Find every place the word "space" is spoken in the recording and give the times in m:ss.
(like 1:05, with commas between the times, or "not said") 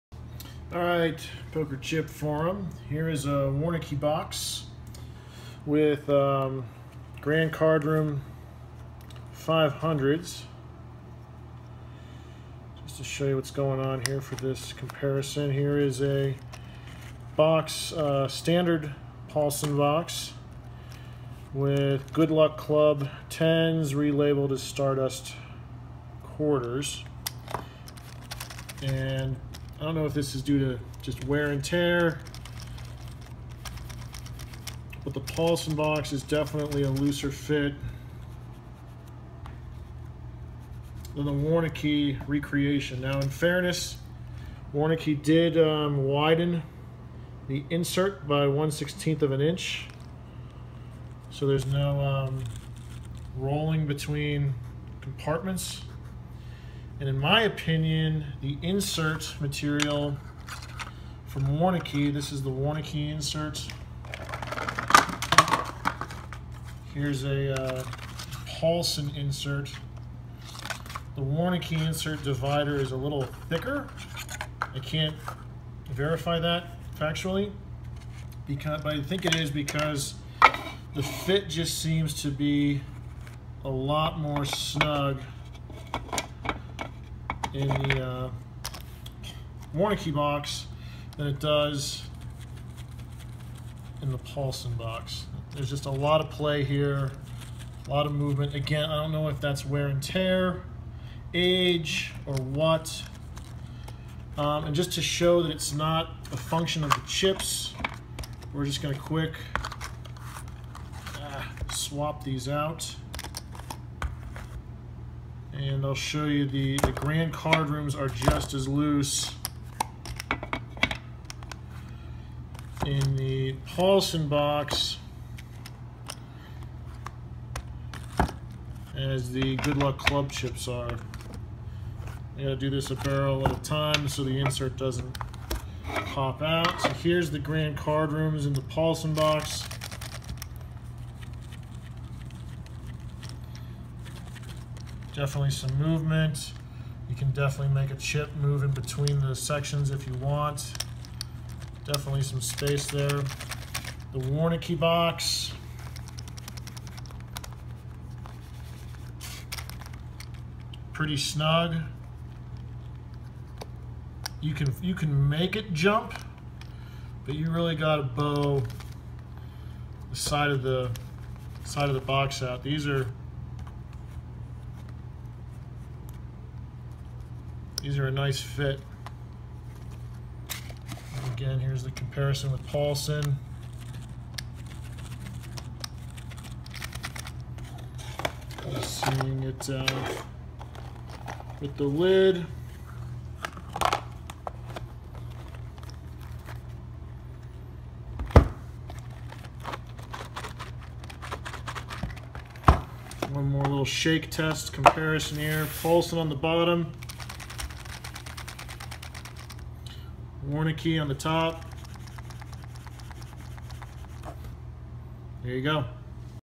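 2:32.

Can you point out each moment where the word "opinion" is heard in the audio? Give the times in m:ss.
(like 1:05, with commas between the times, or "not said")
0:57.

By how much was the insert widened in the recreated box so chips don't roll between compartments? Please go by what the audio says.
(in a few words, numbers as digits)
1/16 of an inch.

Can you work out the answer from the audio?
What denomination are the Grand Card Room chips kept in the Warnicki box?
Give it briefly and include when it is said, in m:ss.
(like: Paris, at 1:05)
500s, at 0:09.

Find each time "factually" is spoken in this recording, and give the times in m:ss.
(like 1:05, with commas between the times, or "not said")
1:16.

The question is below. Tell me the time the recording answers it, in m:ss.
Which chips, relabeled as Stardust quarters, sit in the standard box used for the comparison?
0:22.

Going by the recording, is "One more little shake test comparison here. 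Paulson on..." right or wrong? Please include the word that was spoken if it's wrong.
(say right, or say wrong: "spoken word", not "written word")
right.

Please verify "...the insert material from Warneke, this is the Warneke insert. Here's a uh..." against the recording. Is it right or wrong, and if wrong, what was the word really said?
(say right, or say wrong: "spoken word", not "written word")
right.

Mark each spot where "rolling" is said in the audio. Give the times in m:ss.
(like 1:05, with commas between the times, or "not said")
0:53.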